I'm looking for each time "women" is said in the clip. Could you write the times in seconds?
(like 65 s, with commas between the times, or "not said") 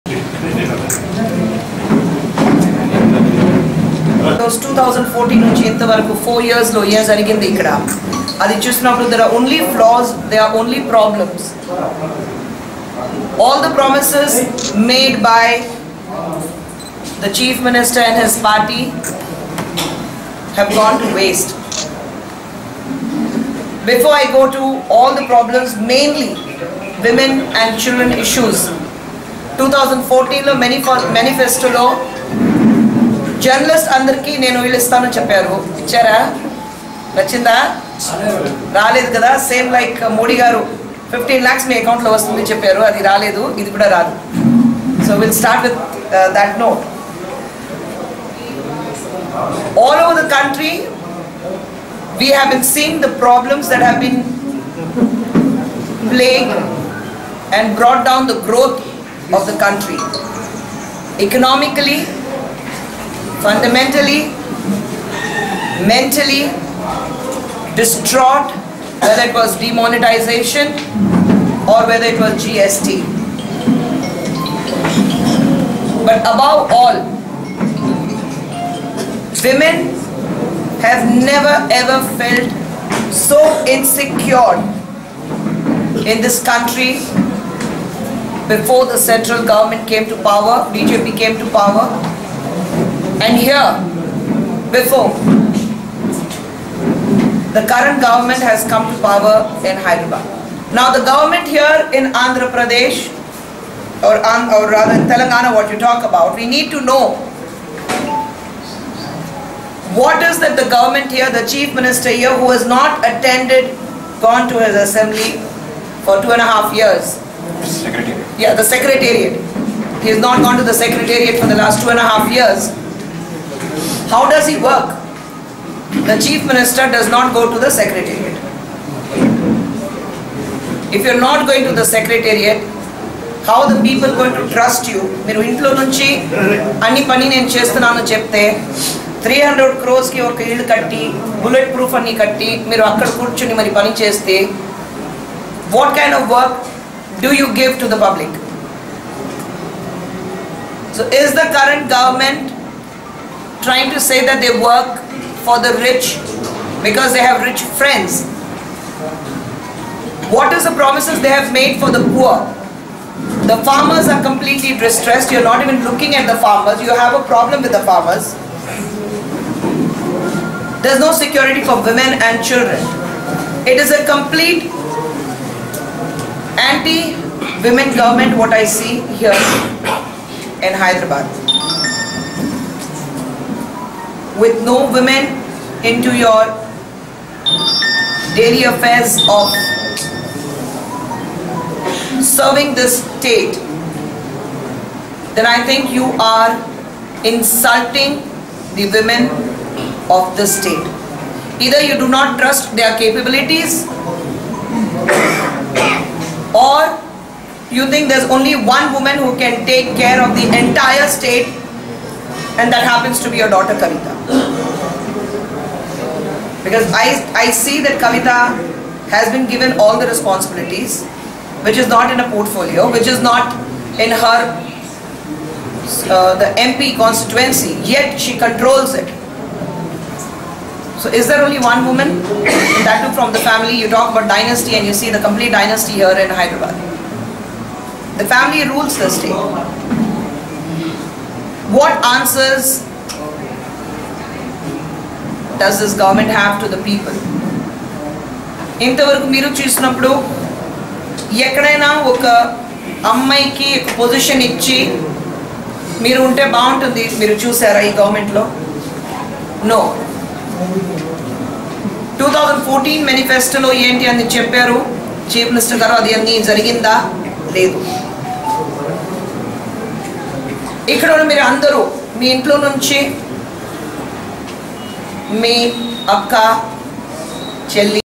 27 s, 79 s, 171 s, 176 s, 184 s, 198 s.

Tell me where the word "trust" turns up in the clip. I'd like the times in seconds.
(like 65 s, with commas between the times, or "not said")
134 s, 202 s.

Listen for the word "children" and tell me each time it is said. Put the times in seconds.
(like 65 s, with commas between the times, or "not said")
27 s, 172 s.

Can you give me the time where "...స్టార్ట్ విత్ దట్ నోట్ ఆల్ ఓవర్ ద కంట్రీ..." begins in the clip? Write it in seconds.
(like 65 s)
45 s.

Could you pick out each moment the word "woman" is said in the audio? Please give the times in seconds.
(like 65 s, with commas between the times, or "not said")
208 s, 231 s.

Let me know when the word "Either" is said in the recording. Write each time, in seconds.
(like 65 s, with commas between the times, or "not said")
201 s.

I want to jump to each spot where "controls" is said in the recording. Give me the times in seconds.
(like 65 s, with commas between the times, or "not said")
228 s.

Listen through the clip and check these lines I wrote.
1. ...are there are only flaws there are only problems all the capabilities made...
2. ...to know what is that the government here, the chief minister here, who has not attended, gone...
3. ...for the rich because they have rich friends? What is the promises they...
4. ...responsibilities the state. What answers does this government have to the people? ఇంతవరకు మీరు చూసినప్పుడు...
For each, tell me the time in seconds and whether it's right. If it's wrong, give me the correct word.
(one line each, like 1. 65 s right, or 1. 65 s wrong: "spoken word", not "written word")
1. 8 s wrong: "promises", not "capabilities"
2. 106 s right
3. 155 s right
4. 238 s wrong: "rules", not "responsibilities".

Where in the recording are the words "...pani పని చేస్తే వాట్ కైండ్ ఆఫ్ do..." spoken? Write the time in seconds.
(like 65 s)
143 s.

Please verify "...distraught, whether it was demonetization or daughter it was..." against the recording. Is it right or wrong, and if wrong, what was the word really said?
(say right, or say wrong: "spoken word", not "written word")
wrong: "whether", not "daughter".